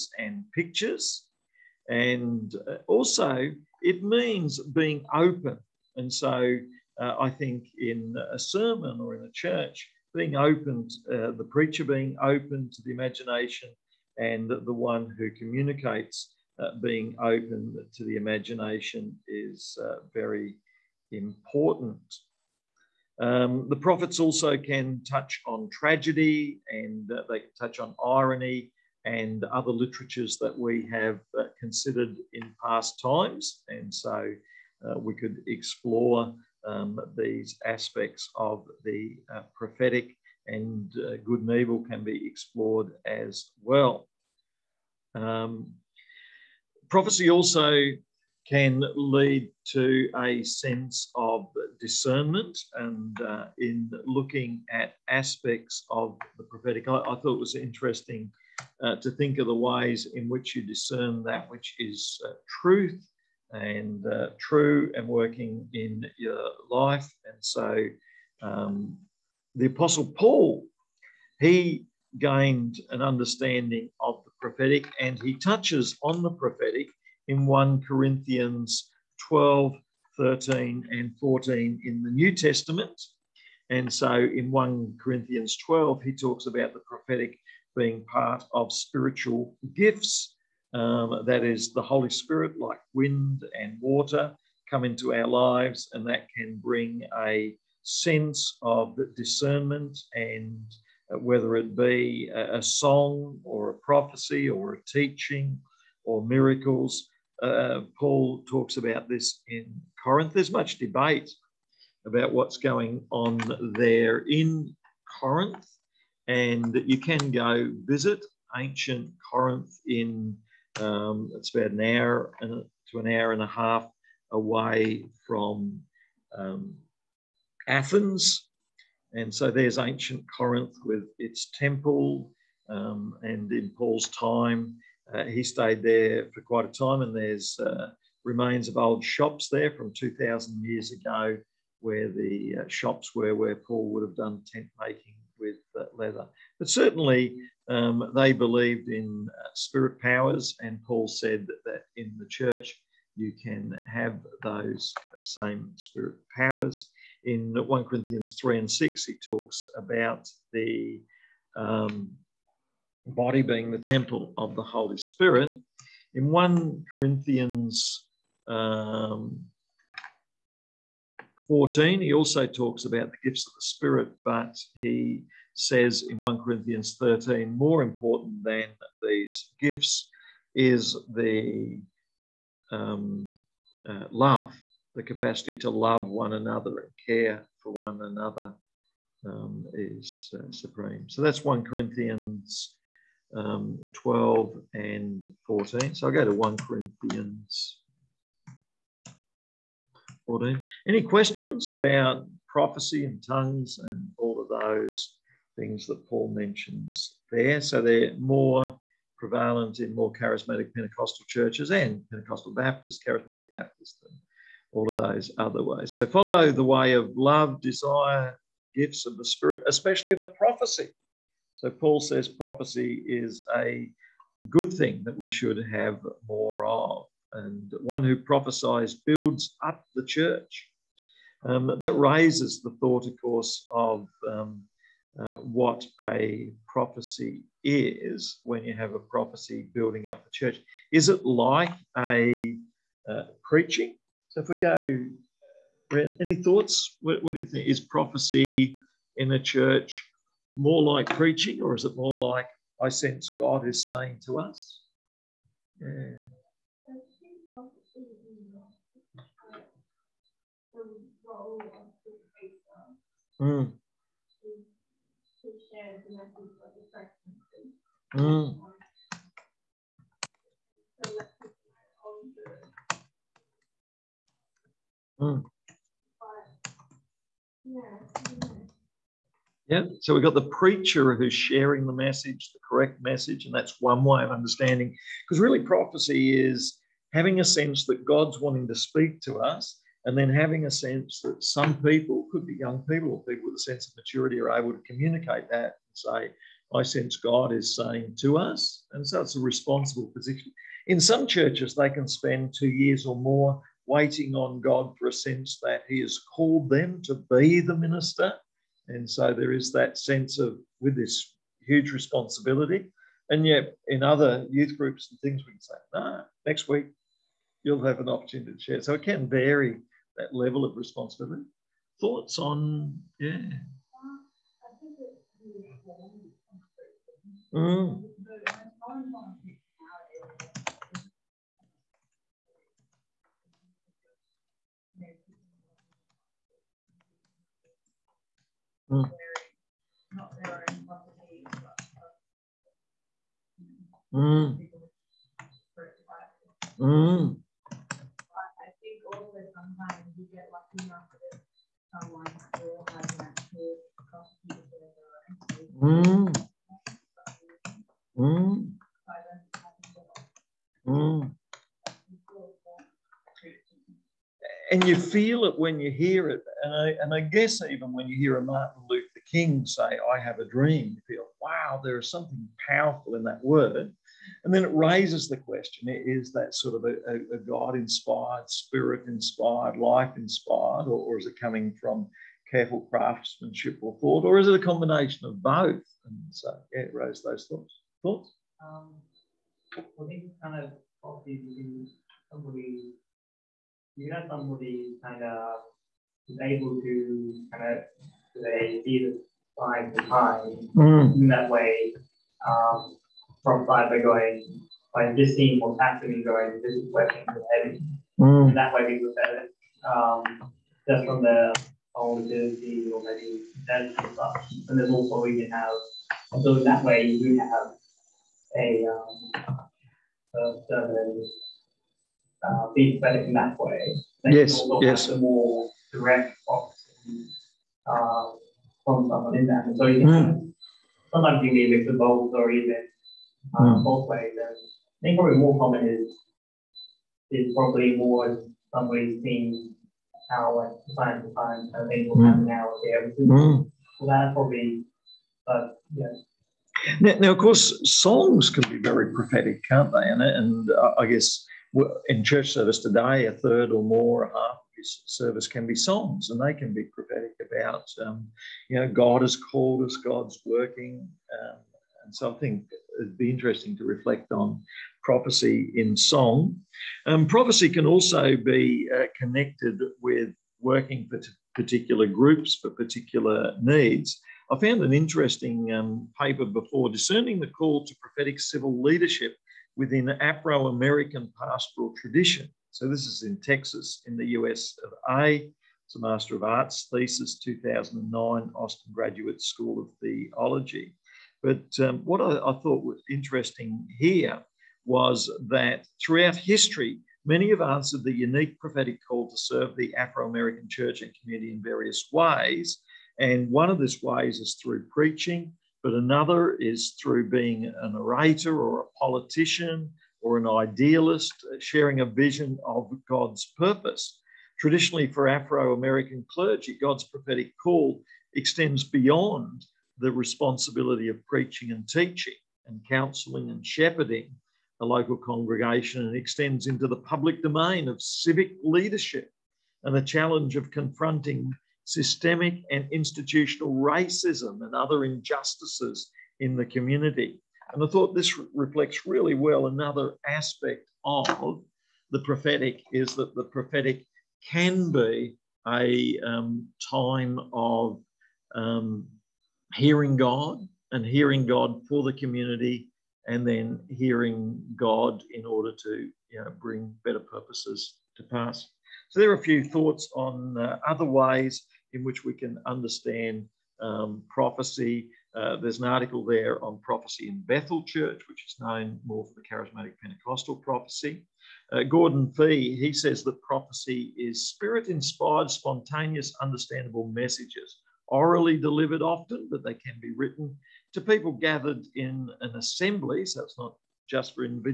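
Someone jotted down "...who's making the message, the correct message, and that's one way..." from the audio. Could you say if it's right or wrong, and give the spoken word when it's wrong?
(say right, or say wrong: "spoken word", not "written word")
wrong: "sharing", not "making".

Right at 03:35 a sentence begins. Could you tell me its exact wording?
So follow the way of love, desire, gifts of the Spirit, especially the prophecy.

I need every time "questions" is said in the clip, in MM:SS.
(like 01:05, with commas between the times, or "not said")
03:21, 06:15.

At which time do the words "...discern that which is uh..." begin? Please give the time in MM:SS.
01:00.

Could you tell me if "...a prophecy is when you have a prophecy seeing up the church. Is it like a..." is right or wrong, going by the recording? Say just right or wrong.
wrong.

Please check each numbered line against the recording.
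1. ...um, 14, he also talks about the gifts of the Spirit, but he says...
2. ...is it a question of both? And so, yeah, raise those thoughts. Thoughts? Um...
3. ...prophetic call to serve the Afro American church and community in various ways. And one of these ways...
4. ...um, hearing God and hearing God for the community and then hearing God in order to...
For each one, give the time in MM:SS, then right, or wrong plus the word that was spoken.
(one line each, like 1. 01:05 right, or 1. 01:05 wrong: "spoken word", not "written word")
1. 02:48 right
2. 06:24 wrong: "combination", not "question"
3. 08:18 right
4. 09:08 right.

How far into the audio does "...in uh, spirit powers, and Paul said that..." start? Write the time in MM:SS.
02:28.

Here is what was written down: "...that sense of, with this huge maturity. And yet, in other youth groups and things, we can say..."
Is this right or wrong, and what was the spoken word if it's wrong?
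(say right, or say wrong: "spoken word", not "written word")
wrong: "responsibility", not "maturity".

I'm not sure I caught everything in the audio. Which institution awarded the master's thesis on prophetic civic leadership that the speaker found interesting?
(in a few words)
Austin Graduate School of Theology.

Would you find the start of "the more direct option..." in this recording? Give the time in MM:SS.
07:05.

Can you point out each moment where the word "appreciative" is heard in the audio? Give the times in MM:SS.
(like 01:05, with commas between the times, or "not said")
not said.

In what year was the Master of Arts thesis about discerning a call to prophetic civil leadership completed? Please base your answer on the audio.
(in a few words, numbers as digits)
2009.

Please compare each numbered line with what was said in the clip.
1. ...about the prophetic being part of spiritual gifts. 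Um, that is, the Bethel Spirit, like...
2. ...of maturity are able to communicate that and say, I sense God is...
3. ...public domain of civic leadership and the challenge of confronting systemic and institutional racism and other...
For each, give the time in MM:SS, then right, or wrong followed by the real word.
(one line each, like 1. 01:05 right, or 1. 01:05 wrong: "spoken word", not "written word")
1. 01:26 wrong: "Holy", not "Bethel"
2. 04:53 right
3. 08:46 right.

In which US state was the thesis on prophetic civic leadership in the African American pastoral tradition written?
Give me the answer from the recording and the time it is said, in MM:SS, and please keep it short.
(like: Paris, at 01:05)
Texas, at 08:03.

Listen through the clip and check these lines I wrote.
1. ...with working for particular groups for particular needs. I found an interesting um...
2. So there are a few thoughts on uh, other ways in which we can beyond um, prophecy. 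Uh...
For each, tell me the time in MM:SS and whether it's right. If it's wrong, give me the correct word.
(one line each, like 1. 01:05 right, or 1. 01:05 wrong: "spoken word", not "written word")
1. 07:50 right
2. 09:19 wrong: "understand", not "beyond".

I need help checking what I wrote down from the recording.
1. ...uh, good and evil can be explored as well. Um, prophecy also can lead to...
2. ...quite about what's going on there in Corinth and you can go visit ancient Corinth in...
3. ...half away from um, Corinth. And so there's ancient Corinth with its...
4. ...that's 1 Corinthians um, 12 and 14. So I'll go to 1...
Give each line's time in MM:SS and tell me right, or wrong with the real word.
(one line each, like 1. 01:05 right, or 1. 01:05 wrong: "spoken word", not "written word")
1. 00:41 right
2. 01:50 wrong: "debate", not "quite"
3. 02:03 wrong: "Athens", not "Corinth"
4. 03:11 right.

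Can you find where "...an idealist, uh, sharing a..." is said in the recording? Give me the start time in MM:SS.
08:30.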